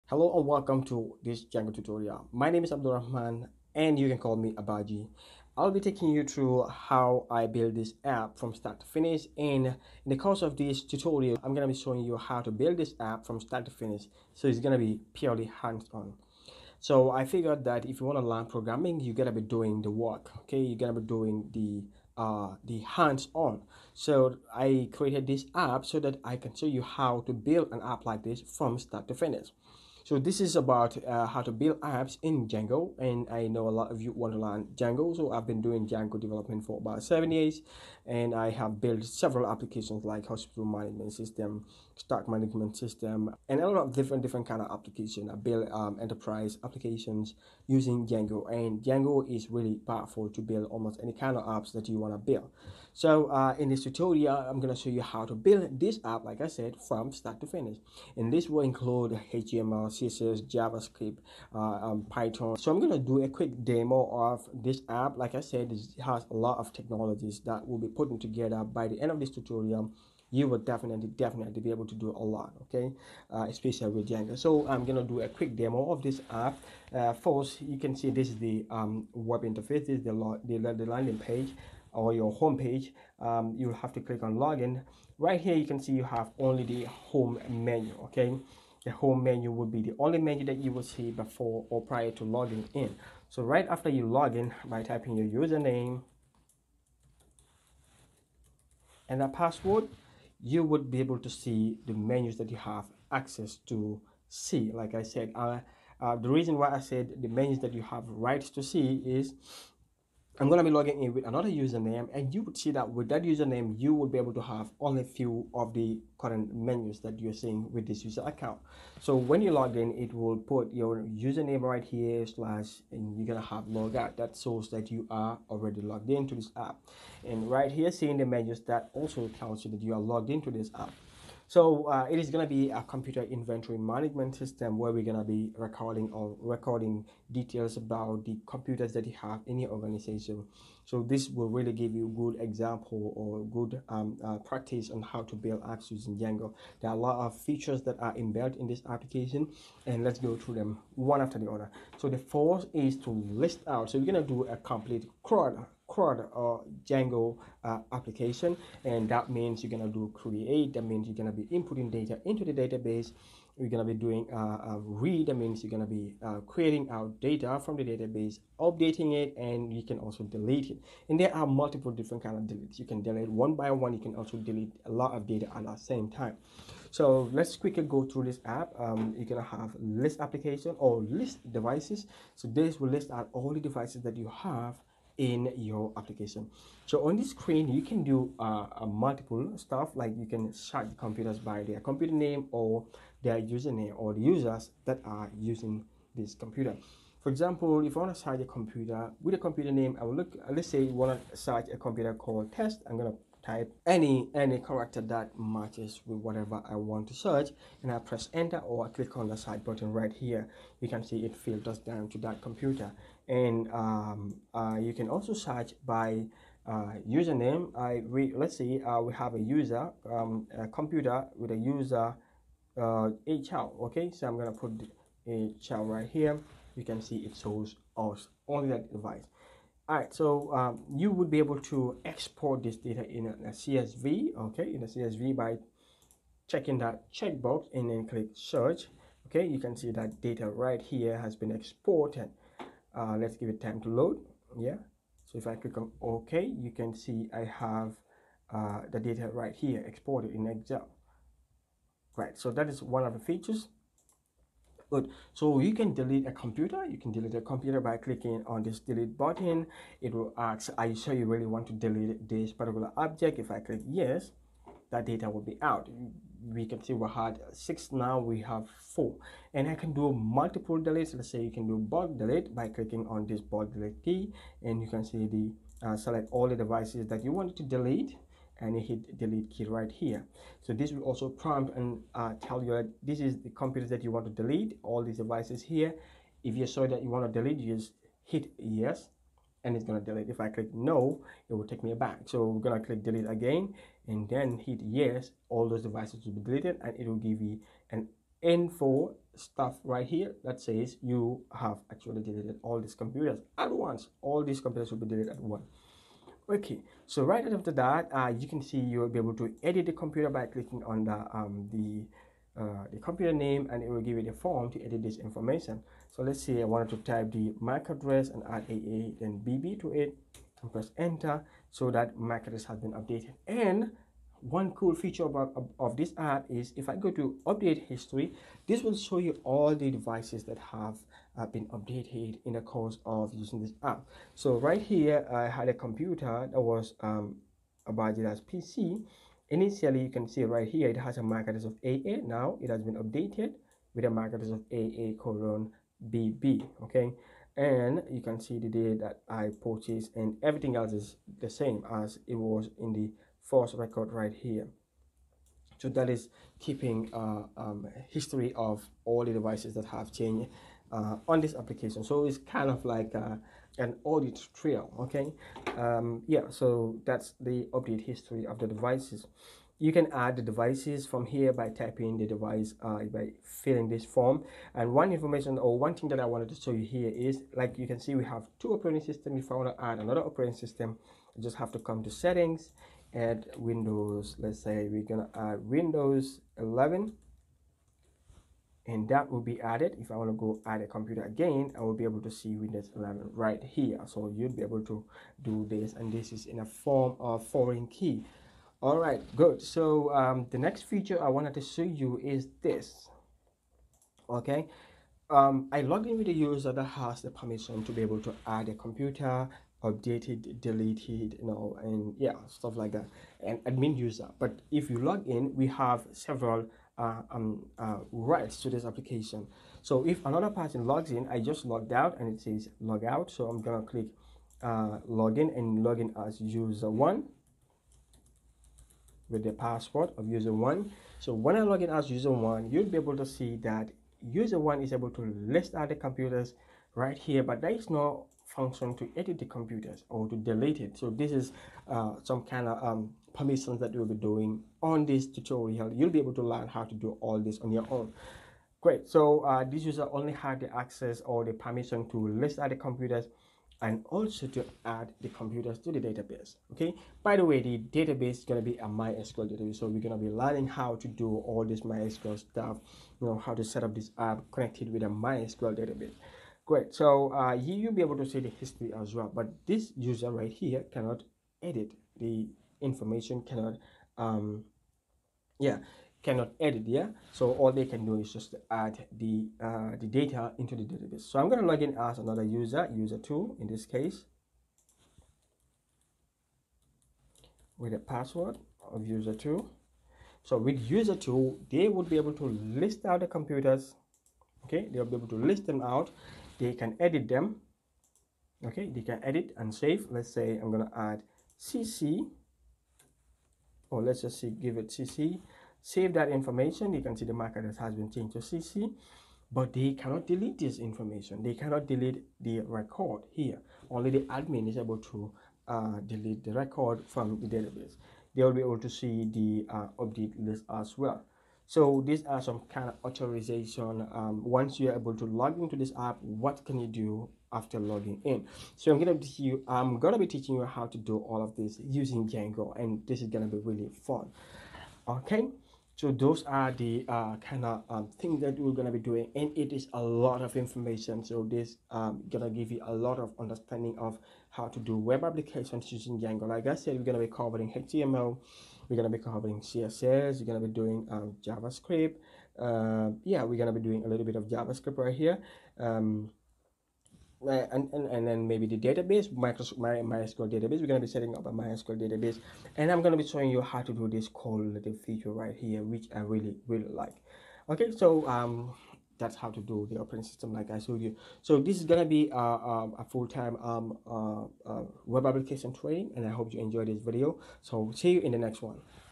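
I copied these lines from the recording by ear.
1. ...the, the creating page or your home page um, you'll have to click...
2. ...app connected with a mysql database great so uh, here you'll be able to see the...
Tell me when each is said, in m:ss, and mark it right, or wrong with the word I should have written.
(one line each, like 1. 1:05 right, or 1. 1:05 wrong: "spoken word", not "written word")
1. 1:20 wrong: "landing", not "creating"
2. 7:44 right.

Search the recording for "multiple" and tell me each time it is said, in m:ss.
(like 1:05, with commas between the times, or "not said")
2:51, 3:08, 4:30.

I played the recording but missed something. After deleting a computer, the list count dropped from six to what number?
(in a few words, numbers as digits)
4.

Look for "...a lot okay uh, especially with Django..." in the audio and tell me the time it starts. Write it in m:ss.
1:12.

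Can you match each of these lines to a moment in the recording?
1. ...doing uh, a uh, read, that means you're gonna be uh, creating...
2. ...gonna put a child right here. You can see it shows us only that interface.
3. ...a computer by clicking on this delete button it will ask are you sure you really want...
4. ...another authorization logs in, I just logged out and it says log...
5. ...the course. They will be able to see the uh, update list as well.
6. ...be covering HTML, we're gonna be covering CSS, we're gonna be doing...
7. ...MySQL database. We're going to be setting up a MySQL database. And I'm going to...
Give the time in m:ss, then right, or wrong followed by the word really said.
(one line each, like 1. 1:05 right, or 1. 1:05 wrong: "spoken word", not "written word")
1. 2:43 right
2. 3:44 wrong: "device", not "interface"
3. 4:17 right
4. 7:00 wrong: "person", not "authorization"
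5. 8:37 wrong: "database", not "course"
6. 9:07 right
7. 9:19 right.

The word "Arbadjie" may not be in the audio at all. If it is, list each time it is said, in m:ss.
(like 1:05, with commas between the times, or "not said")
0:04.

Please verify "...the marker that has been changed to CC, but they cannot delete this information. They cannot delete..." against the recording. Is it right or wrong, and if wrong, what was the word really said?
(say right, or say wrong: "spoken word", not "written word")
right.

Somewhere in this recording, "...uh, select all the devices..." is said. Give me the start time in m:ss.
4:35.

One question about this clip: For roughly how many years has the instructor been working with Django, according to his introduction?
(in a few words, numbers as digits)
7.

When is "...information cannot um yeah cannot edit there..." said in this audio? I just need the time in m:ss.
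7:52.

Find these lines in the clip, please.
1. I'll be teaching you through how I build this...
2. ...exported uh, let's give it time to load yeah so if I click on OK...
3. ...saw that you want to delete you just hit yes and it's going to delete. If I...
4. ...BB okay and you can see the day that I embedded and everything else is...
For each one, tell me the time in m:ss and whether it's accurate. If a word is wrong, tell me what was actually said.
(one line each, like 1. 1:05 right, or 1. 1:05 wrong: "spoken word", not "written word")
1. 0:05 wrong: "taking", not "teaching"
2. 4:01 right
3. 4:46 right
4. 5:46 wrong: "purchased", not "embedded".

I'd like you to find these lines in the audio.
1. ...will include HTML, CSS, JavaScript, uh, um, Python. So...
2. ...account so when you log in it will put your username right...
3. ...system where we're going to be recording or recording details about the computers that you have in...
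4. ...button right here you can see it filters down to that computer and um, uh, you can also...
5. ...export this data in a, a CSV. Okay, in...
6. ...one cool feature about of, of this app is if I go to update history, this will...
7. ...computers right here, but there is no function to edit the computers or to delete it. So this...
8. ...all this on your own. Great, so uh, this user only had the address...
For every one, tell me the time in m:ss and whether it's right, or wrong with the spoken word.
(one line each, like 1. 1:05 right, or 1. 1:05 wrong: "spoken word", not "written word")
1. 0:58 right
2. 1:58 right
3. 2:14 right
4. 3:29 right
5. 3:52 right
6. 5:24 right
7. 7:15 right
8. 7:27 wrong: "access", not "address".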